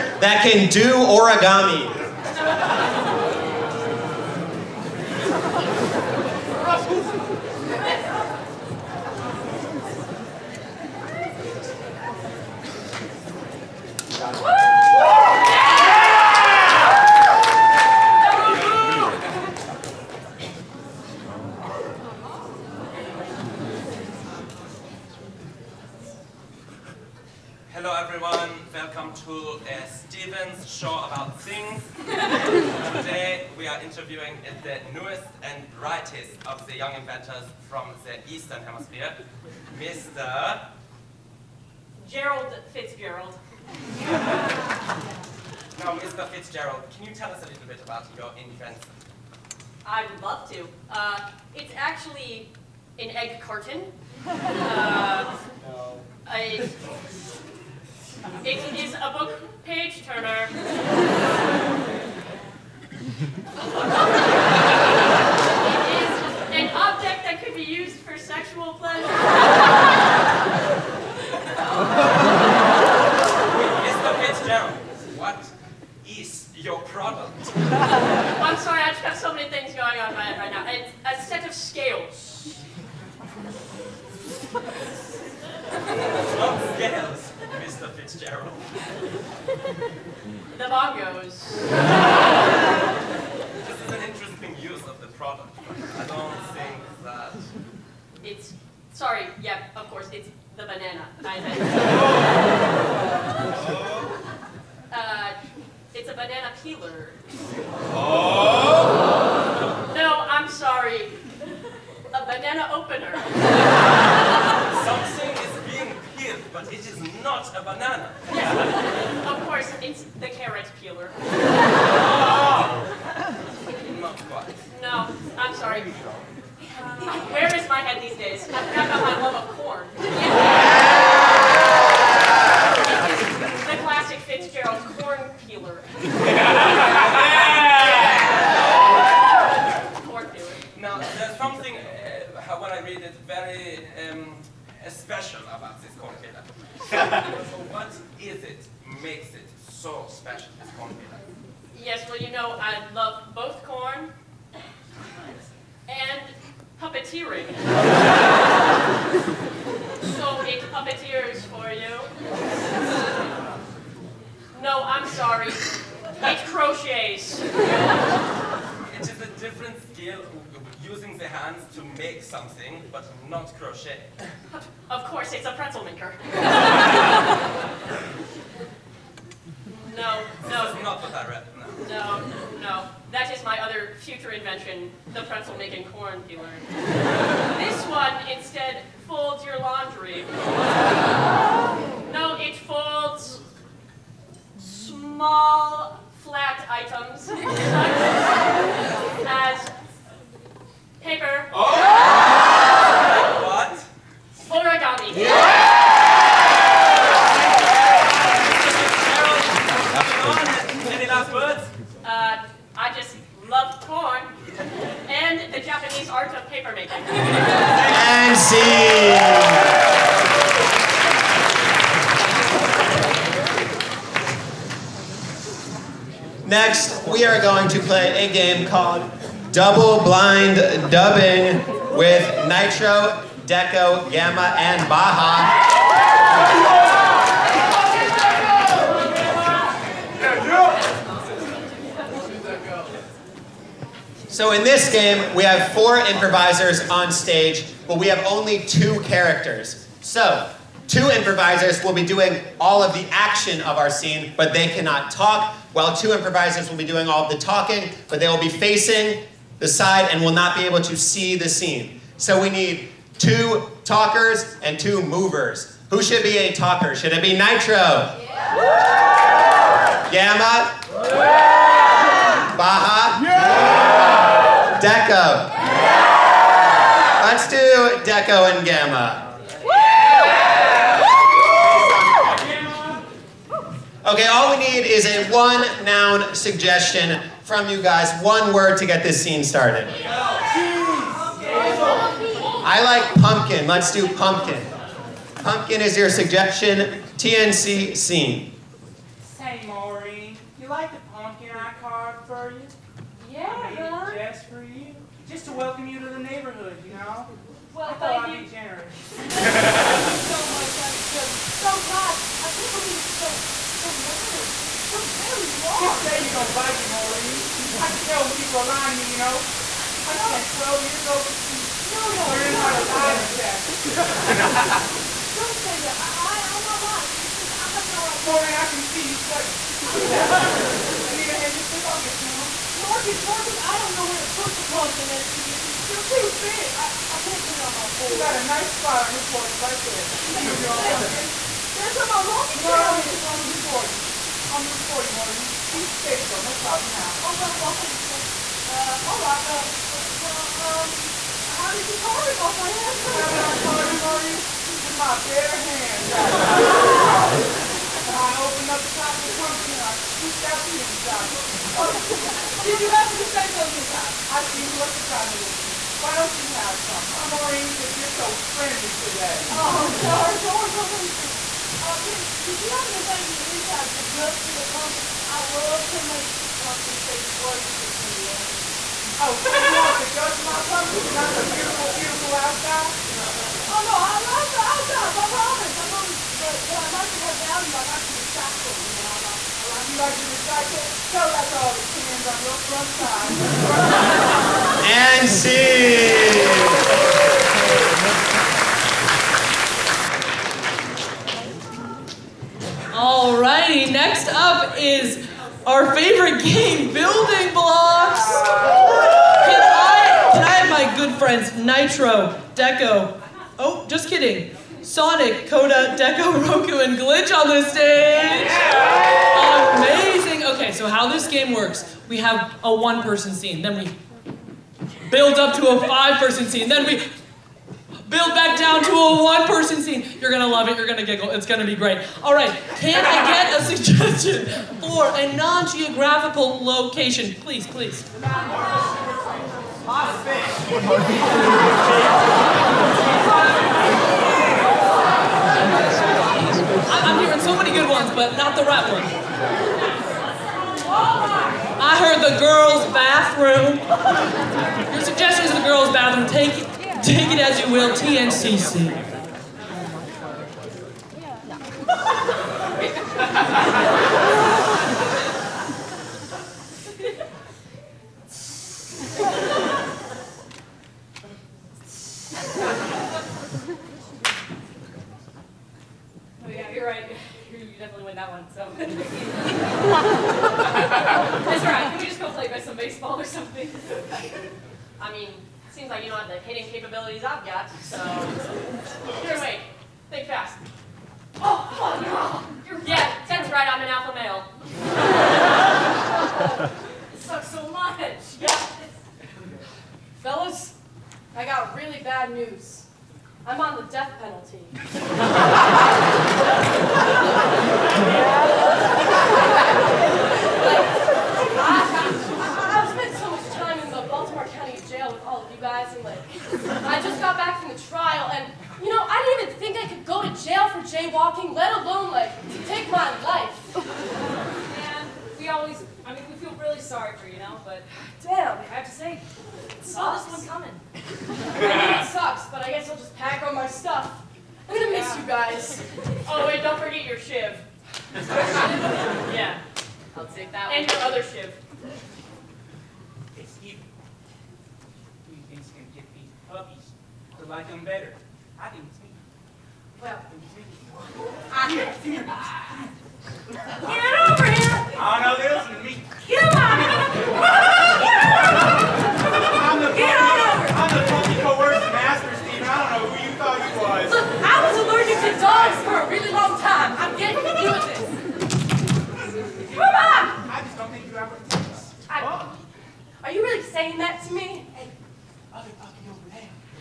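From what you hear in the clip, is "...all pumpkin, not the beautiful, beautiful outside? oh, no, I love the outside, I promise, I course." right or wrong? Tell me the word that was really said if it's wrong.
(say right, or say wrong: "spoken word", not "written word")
wrong: "promise", not "course".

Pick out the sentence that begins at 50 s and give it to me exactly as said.
Uh, it's actually an egg carton.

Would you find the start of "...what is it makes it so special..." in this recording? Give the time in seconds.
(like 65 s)
147 s.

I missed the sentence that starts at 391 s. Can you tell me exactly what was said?
Tell that to all the cans on your front side.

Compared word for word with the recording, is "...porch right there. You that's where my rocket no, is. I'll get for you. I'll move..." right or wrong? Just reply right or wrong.
right.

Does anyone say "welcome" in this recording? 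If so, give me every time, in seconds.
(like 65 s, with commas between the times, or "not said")
28 s, 305 s.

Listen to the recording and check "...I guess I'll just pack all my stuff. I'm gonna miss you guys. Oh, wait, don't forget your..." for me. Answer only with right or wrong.
right.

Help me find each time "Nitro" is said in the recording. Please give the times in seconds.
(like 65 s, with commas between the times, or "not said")
232 s, 267 s, 411 s.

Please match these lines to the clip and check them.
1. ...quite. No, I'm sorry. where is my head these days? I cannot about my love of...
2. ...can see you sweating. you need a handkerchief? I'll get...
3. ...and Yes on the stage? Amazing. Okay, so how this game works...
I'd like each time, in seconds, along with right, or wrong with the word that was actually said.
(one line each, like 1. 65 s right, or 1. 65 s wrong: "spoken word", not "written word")
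1. 124 s wrong: "forgot", not "cannot"
2. 328 s right
3. 416 s wrong: "Glitch", not "Yes".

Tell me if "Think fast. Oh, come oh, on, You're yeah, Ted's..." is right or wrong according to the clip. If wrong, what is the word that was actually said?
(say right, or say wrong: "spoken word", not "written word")
right.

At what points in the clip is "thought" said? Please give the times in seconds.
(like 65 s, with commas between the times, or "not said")
307 s, 563 s.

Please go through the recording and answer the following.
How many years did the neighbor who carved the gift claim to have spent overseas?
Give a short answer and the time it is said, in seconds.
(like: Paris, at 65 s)
12, at 320 s.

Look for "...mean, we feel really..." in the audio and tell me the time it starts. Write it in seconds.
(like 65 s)
526 s.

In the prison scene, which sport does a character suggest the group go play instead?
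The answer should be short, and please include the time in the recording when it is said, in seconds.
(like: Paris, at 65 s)
Baseball, at 482 s.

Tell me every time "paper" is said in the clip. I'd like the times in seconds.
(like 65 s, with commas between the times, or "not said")
201 s, 216 s.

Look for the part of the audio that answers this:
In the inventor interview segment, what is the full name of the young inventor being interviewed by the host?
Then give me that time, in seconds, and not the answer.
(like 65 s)
39 s.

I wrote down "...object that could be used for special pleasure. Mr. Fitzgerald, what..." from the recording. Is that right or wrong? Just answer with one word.
wrong.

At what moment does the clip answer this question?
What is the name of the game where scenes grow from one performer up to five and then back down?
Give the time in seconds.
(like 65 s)
406 s.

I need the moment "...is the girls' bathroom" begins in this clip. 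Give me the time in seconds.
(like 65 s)
455 s.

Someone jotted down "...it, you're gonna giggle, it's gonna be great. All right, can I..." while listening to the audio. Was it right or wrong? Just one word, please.
right.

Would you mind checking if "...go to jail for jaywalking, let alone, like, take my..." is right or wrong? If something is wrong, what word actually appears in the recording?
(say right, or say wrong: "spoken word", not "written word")
right.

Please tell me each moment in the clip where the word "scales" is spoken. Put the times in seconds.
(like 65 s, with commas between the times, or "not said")
81 s, 86 s.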